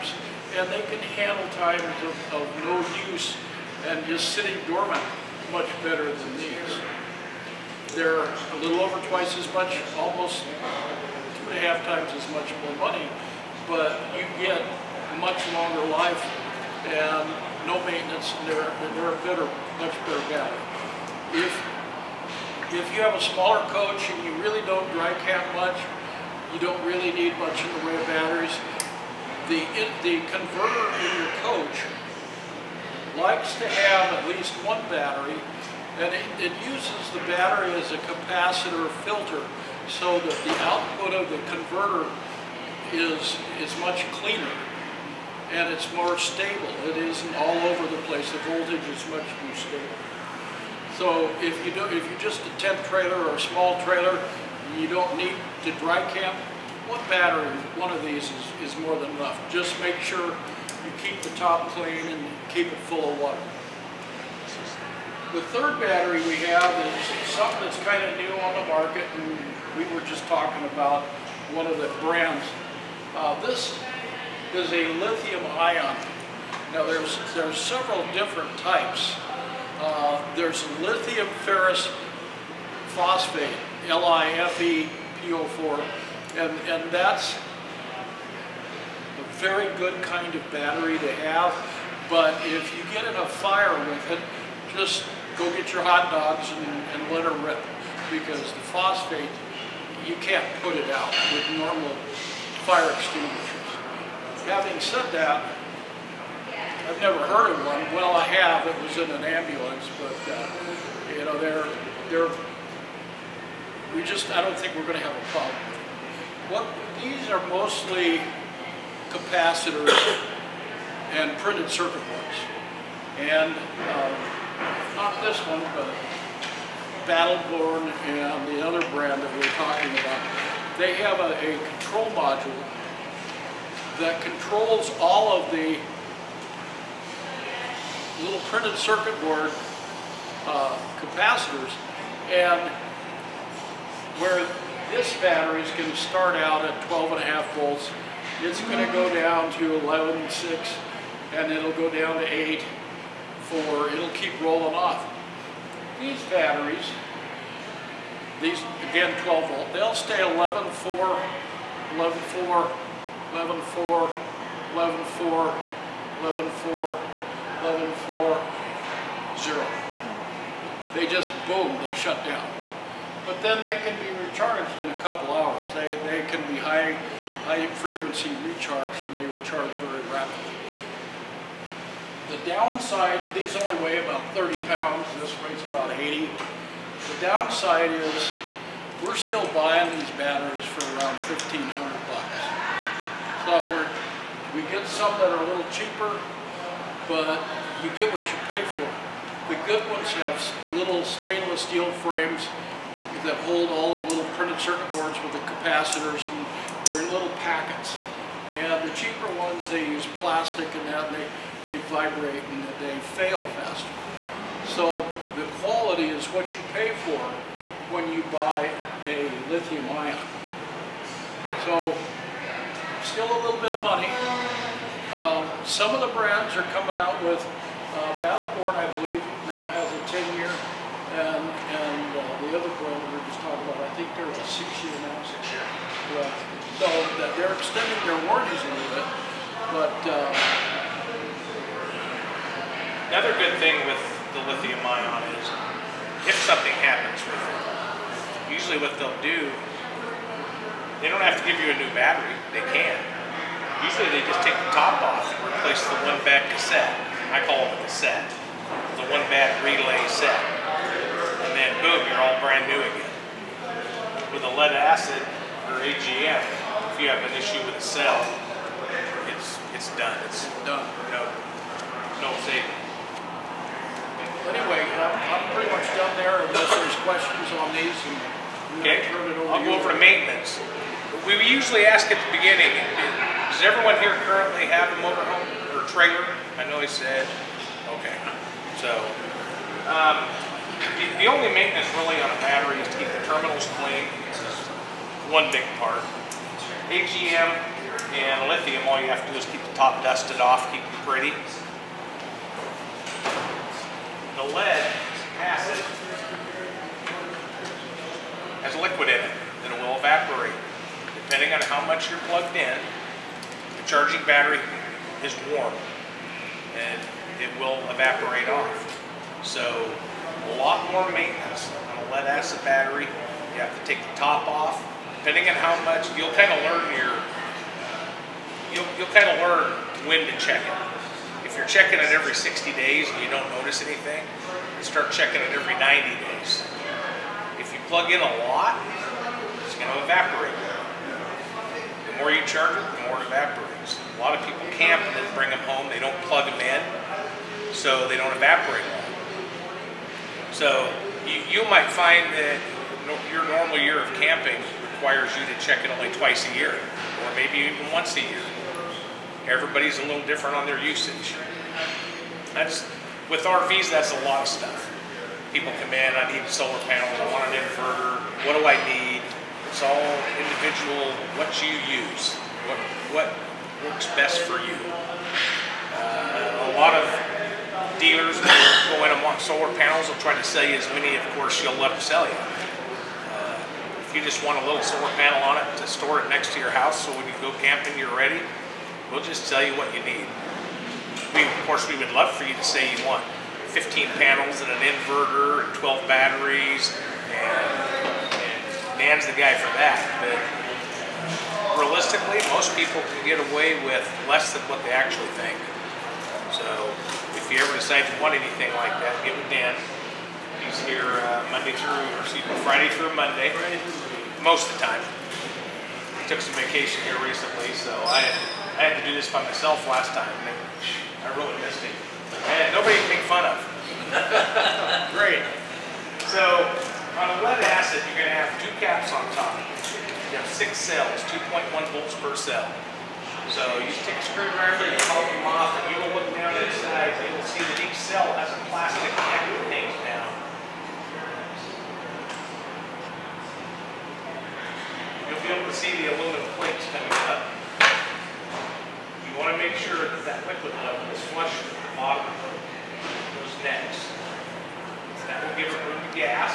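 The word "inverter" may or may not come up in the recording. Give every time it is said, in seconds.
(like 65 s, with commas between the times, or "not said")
367 s, 394 s.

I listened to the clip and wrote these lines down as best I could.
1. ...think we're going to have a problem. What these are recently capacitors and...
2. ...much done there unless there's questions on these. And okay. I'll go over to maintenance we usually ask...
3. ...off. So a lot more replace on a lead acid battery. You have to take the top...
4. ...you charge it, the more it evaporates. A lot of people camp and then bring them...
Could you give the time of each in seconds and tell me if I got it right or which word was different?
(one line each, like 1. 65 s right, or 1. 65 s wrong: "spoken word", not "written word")
1. 114 s wrong: "mostly", not "recently"
2. 275 s right
3. 318 s wrong: "maintenance", not "replace"
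4. 342 s right.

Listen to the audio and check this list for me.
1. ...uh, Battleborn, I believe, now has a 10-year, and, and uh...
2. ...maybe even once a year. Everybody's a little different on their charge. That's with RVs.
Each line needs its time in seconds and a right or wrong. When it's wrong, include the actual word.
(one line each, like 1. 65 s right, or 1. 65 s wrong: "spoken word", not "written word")
1. 227 s right
2. 357 s wrong: "usage", not "charge".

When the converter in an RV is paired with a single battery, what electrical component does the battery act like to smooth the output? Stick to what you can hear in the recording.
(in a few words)
capacitor filter.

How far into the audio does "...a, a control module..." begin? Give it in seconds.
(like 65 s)
131 s.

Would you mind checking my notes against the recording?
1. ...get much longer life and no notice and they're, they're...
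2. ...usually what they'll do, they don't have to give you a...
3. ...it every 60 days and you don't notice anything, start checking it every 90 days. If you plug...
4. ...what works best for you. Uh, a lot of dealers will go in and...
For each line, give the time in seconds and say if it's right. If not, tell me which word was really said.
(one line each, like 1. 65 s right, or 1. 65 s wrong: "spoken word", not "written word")
1. 14 s wrong: "maintenance", not "notice"
2. 248 s right
3. 331 s right
4. 373 s right.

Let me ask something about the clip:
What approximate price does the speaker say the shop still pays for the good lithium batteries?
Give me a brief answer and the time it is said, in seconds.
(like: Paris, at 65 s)
$1,500, at 191 s.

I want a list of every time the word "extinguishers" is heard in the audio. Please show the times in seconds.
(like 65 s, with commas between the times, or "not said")
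102 s.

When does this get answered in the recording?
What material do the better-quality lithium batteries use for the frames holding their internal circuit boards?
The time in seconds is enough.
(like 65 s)
201 s.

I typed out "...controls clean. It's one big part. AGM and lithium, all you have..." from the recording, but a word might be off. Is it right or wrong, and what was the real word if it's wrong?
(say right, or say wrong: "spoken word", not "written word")
wrong: "terminals", not "controls".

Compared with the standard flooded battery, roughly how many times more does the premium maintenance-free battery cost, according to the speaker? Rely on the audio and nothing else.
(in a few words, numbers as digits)
2.5 times.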